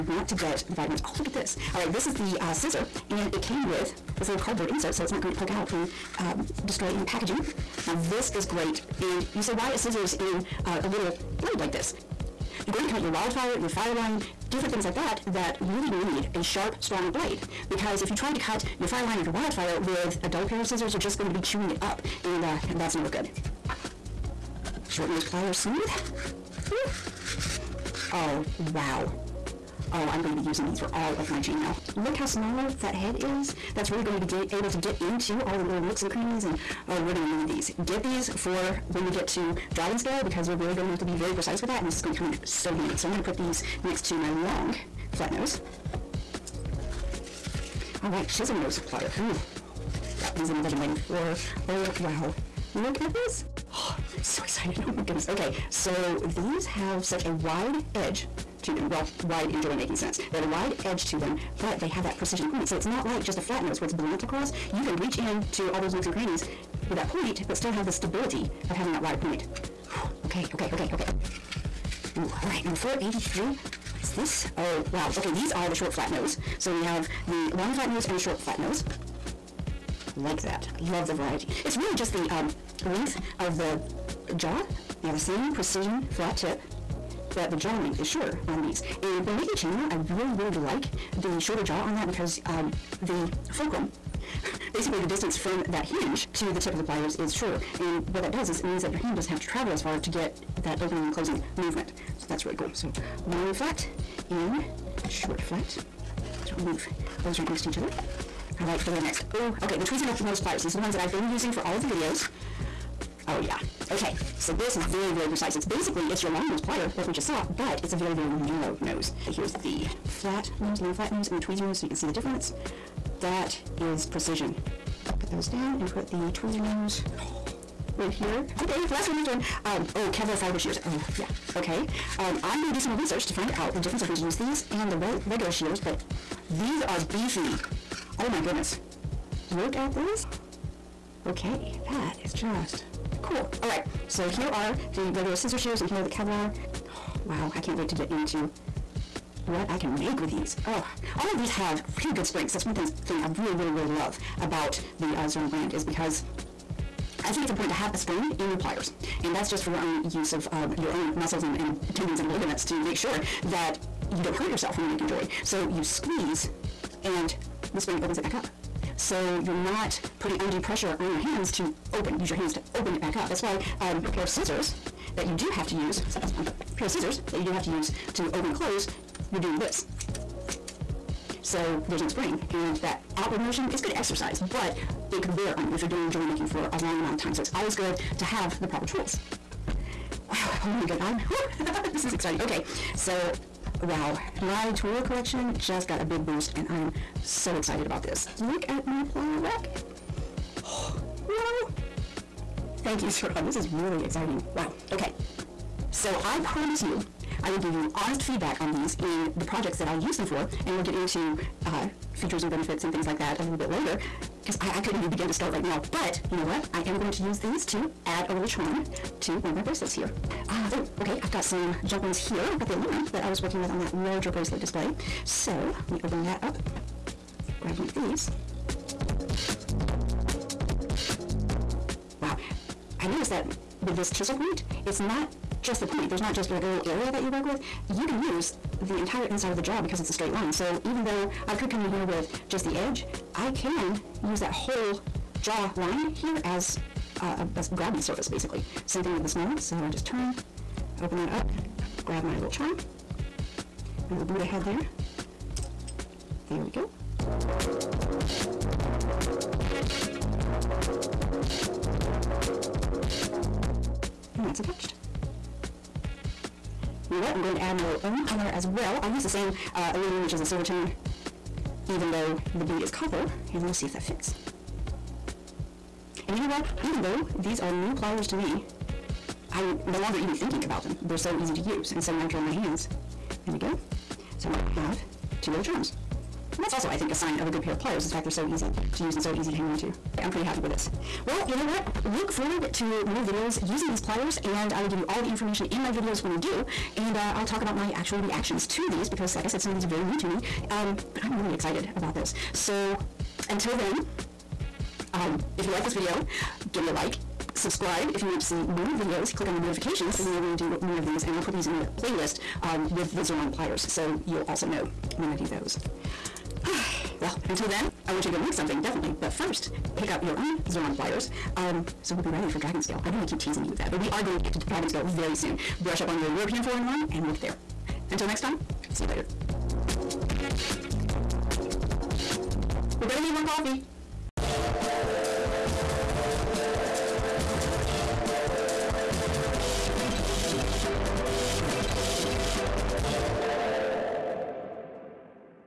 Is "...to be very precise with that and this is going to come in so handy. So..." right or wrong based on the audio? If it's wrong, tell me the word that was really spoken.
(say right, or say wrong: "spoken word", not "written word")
right.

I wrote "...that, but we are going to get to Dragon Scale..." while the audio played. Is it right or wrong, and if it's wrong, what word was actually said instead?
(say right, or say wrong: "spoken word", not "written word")
right.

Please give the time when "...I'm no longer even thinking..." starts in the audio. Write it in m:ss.
4:39.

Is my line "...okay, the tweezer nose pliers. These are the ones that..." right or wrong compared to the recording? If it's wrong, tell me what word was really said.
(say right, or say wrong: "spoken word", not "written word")
right.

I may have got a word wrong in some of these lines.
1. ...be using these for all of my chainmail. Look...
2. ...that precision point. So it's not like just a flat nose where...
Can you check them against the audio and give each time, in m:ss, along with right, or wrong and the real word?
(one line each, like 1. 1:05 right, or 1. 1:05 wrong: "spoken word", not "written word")
1. 0:30 right
2. 1:02 right.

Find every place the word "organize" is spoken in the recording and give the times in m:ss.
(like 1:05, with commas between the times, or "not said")
not said.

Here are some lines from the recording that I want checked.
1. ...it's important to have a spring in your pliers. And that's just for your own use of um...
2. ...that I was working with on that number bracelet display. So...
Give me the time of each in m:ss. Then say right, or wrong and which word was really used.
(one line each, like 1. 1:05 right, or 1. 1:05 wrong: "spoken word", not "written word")
1. 2:37 right
2. 3:43 wrong: "larger", not "number".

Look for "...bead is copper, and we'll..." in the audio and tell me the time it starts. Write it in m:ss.
4:32.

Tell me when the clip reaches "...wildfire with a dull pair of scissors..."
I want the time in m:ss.
0:19.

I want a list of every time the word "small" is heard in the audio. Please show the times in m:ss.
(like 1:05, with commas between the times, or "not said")
0:32, 4:09.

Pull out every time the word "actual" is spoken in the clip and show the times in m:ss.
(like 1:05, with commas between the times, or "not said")
4:57.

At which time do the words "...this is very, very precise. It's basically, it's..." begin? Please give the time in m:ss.
1:54.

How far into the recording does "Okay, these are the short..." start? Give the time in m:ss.
1:15.